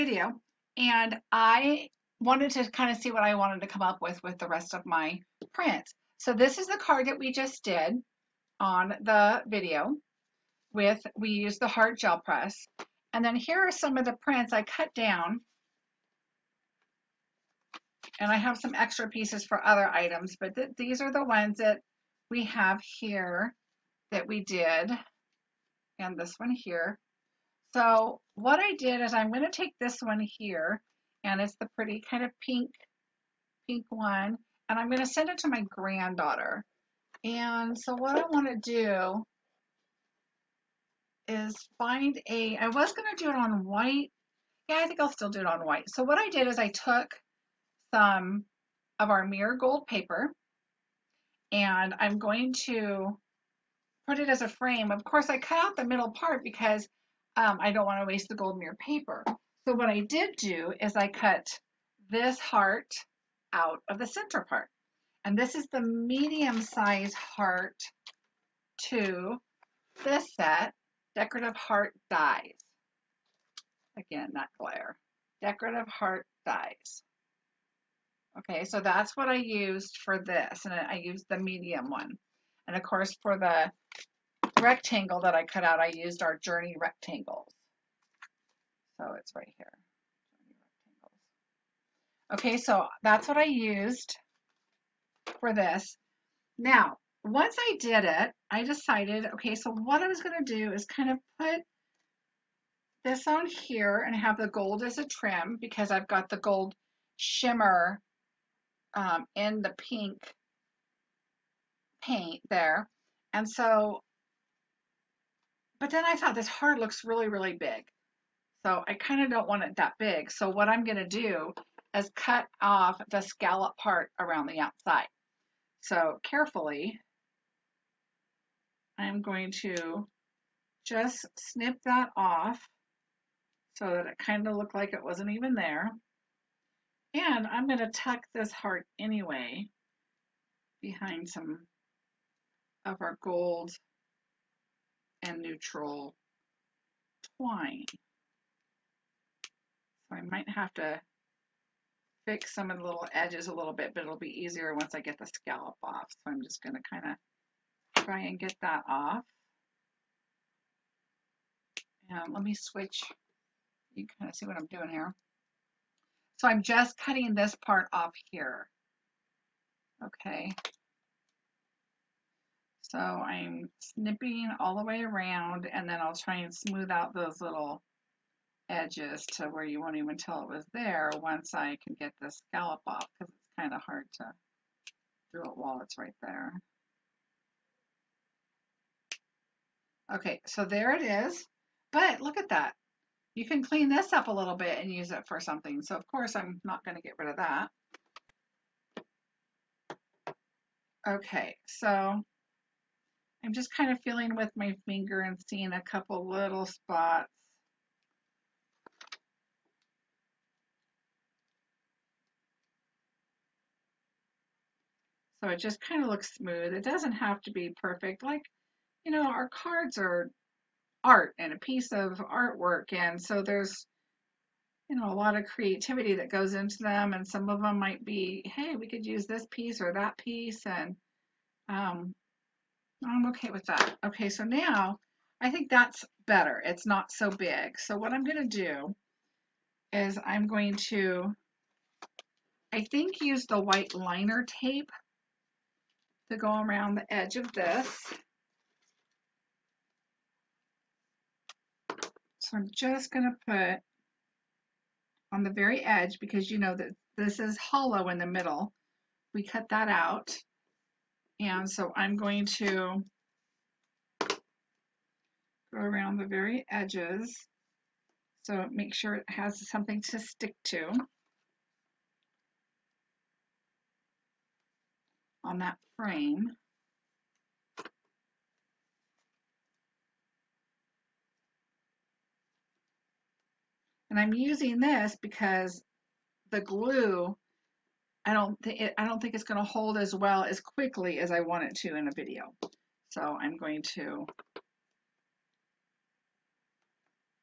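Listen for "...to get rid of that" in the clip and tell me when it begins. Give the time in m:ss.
3:16.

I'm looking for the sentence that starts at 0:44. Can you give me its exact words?
Yeah, I think I'll still do it on white.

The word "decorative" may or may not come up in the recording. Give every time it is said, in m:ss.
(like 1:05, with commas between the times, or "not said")
1:11, 1:15.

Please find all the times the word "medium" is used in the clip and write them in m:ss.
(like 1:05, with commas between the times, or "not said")
1:05, 1:21.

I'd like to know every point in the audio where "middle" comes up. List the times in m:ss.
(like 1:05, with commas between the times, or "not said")
0:55, 4:18.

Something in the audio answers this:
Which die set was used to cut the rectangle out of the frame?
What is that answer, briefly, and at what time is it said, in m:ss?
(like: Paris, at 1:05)
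journey rectangles, at 1:26.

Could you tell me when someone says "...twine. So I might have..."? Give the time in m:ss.
2:27.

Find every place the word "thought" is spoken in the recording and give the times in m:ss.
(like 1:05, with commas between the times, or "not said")
1:56.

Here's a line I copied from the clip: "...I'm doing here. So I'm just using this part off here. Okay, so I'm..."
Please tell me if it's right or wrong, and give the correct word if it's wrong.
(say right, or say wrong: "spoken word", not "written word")
wrong: "cutting", not "using".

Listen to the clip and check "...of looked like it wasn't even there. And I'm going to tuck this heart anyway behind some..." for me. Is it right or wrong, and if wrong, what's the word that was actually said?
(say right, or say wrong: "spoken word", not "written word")
right.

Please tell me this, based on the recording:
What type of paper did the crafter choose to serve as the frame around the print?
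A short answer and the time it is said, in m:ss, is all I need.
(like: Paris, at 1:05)
mirror gold paper, at 0:49.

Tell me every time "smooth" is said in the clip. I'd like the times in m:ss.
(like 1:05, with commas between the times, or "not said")
2:56, 3:36.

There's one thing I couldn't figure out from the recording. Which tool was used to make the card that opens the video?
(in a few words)
heart gel press.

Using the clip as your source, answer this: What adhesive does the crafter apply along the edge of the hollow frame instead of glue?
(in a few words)
white liner tape.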